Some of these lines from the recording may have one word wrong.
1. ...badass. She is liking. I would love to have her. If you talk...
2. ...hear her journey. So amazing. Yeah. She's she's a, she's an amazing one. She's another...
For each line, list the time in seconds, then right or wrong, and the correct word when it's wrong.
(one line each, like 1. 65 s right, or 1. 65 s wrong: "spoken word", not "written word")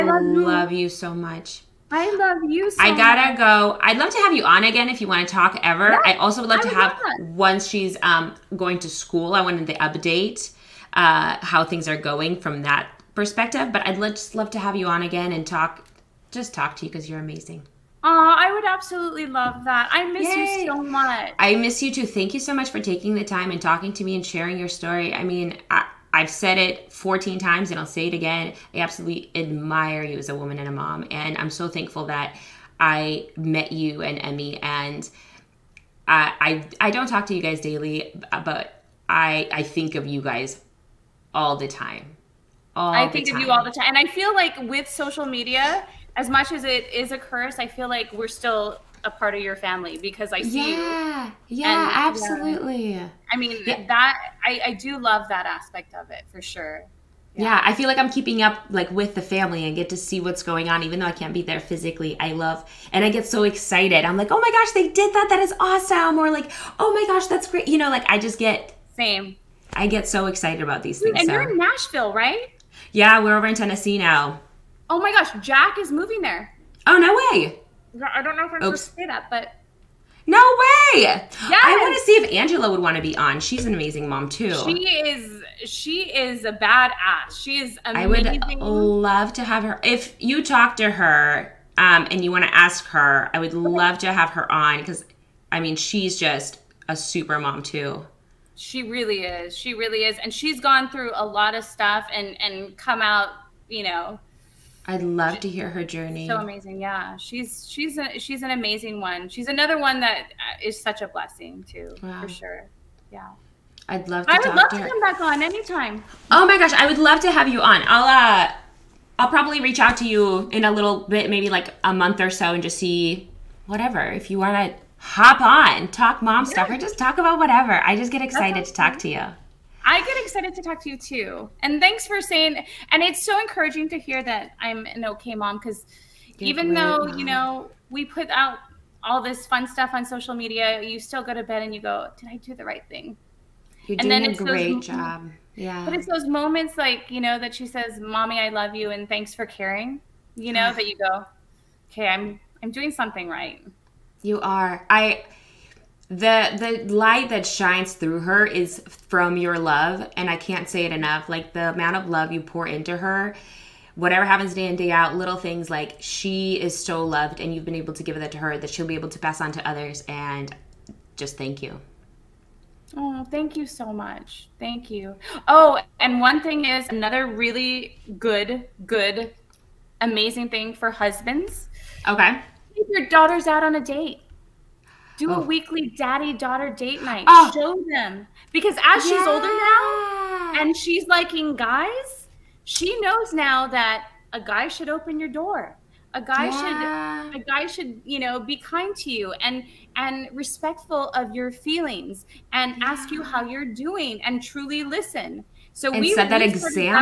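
1. 86 s wrong: "amazing", not "liking"
2. 105 s right.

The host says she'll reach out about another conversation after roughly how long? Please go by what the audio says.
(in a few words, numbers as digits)
a month.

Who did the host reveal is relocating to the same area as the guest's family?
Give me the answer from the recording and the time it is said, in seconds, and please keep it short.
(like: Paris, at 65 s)
Jack, at 75 s.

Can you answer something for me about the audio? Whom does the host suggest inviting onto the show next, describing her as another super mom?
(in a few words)
Angela.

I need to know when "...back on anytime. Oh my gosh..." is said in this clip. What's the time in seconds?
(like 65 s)
114 s.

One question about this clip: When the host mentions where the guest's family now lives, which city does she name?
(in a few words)
Nashville.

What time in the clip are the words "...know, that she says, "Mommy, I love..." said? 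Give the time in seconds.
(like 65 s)
147 s.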